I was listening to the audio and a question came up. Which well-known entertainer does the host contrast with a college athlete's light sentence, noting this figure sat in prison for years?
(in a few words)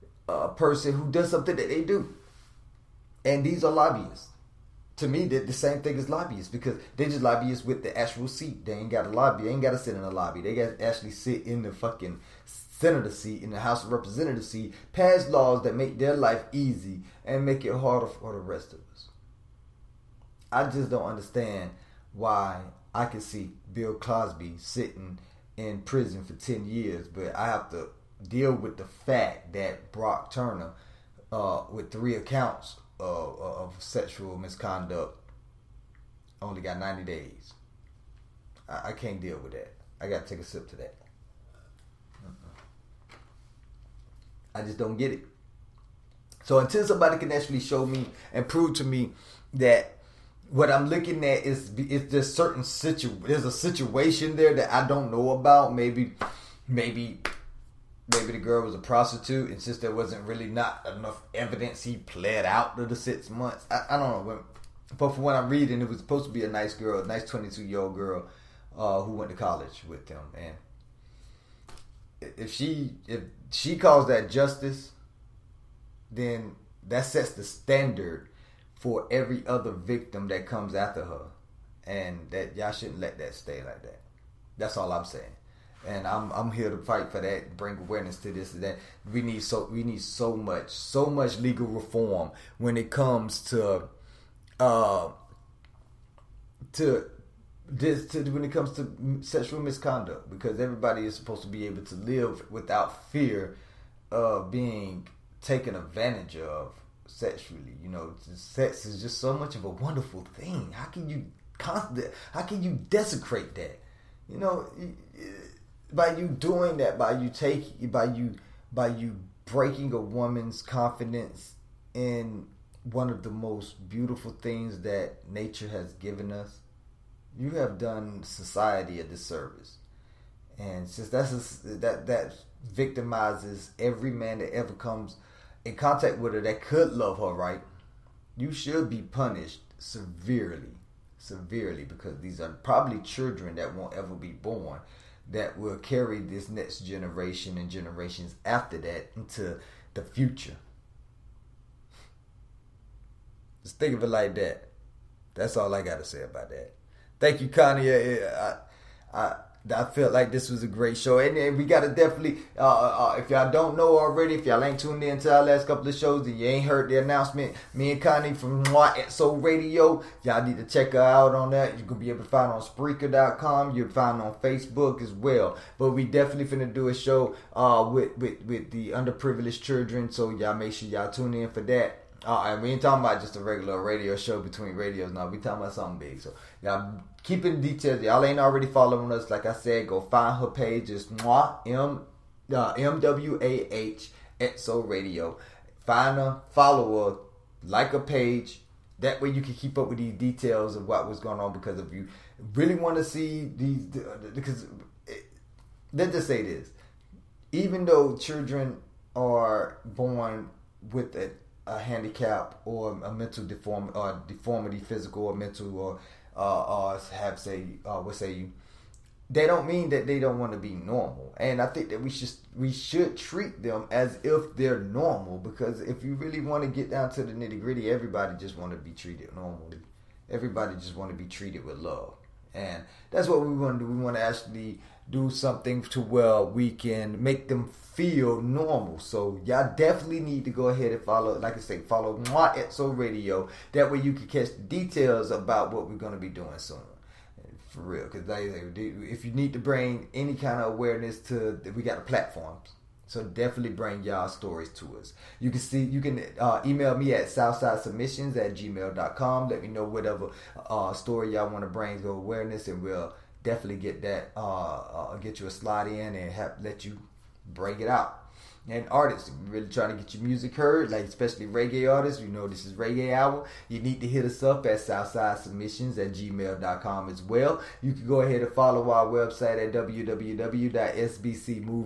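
Bill Cosby.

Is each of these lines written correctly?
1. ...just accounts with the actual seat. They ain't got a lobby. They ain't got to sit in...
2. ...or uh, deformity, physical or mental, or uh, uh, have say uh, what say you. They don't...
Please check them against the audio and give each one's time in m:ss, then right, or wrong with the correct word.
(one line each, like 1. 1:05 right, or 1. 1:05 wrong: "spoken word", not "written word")
1. 0:07 wrong: "lobbyists", not "accounts"
2. 3:33 right.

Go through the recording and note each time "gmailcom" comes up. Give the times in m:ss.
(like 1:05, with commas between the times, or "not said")
4:18, 4:36.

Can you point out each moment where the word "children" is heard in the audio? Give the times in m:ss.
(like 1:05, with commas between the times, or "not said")
2:22, 2:59, 3:28.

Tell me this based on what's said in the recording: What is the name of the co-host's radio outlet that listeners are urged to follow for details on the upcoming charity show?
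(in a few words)
Mwah So Radio.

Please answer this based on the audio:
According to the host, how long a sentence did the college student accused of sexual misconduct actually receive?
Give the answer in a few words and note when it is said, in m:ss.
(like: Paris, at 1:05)
90 days, at 0:36.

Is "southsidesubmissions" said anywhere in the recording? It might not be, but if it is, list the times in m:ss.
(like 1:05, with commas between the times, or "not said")
4:17, 4:34.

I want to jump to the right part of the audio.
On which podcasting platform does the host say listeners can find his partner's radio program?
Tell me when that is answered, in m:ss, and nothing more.
2:52.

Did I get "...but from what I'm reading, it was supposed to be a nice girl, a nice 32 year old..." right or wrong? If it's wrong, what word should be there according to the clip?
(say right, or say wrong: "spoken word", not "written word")
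wrong: "22", not "32".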